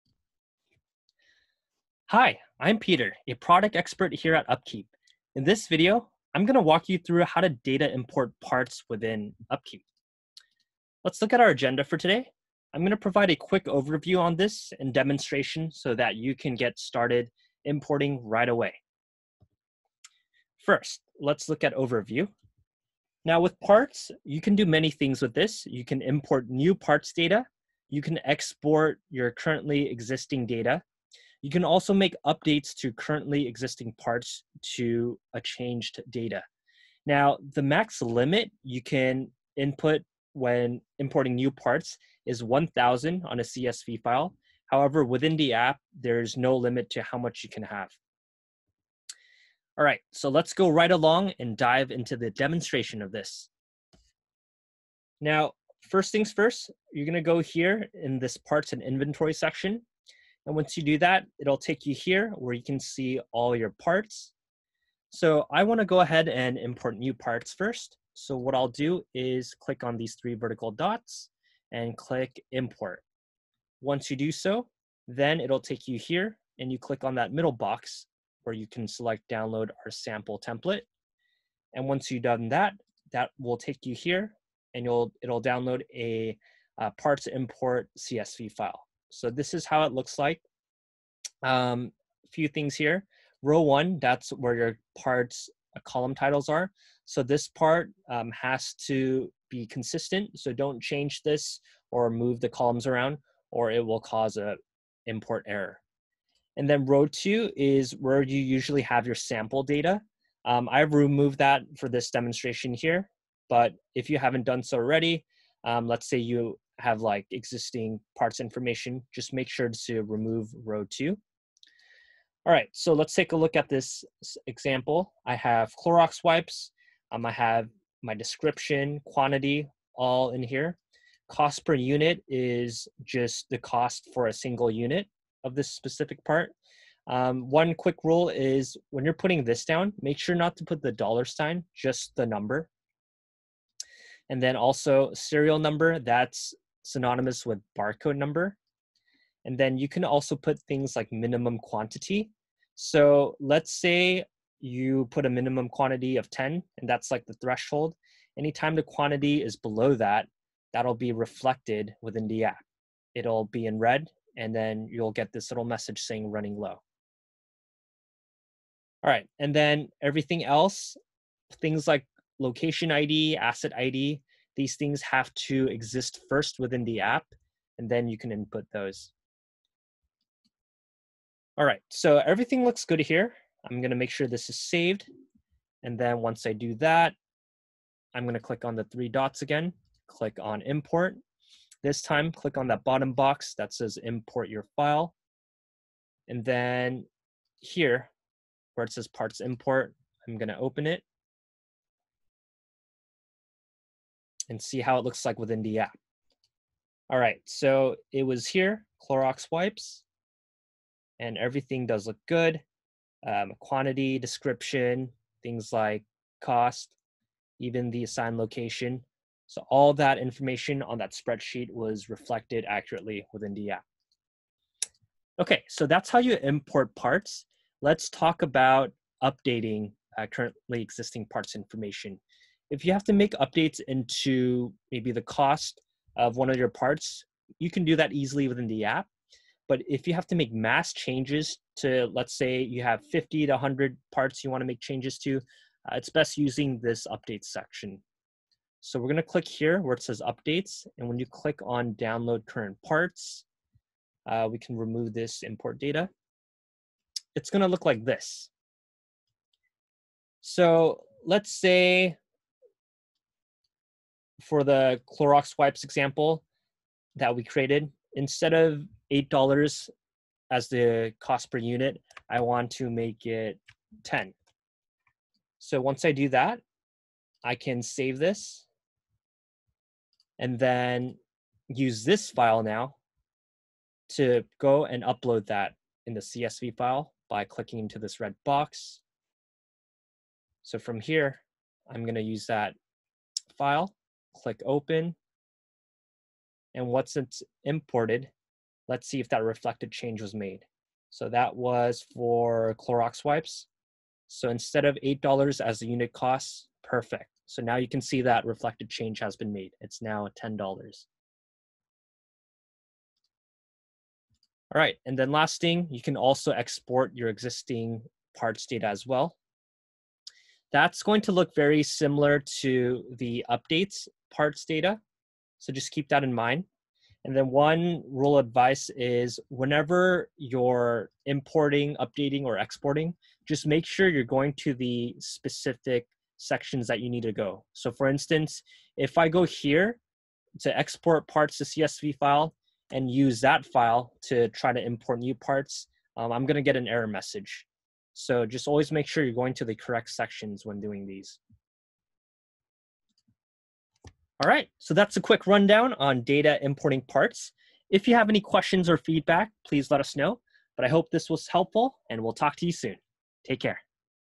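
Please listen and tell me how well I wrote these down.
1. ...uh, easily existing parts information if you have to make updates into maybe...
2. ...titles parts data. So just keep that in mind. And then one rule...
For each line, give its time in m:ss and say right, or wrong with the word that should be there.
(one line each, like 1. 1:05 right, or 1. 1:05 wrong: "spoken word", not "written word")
1. 3:50 wrong: "currently", not "easily"
2. 5:23 wrong: "updates", not "titles".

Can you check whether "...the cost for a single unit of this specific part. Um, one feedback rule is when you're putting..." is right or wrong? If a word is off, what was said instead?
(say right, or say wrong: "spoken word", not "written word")
wrong: "quick", not "feedback".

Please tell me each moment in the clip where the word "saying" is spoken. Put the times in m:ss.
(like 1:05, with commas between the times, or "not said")
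2:46.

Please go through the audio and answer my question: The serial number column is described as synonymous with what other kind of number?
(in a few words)
Barcode number.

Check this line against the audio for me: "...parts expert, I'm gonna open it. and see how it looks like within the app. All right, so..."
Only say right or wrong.
wrong.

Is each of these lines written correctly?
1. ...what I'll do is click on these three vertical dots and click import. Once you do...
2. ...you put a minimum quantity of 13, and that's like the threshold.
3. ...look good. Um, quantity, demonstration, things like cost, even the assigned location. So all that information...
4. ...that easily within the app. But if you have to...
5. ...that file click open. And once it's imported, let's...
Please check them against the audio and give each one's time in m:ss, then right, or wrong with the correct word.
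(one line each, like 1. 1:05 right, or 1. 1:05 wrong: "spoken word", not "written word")
1. 1:08 right
2. 2:34 wrong: "10", not "13"
3. 3:32 wrong: "description", not "demonstration"
4. 3:57 right
5. 4:52 right.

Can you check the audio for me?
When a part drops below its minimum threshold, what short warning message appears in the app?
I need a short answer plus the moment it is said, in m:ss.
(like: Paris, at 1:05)
Running low, at 2:46.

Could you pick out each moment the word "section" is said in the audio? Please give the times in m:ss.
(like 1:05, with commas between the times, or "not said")
0:59, 4:07, 5:36, 5:50.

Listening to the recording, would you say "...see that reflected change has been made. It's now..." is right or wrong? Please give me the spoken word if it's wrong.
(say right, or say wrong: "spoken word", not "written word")
right.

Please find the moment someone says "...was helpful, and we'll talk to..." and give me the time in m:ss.
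6:01.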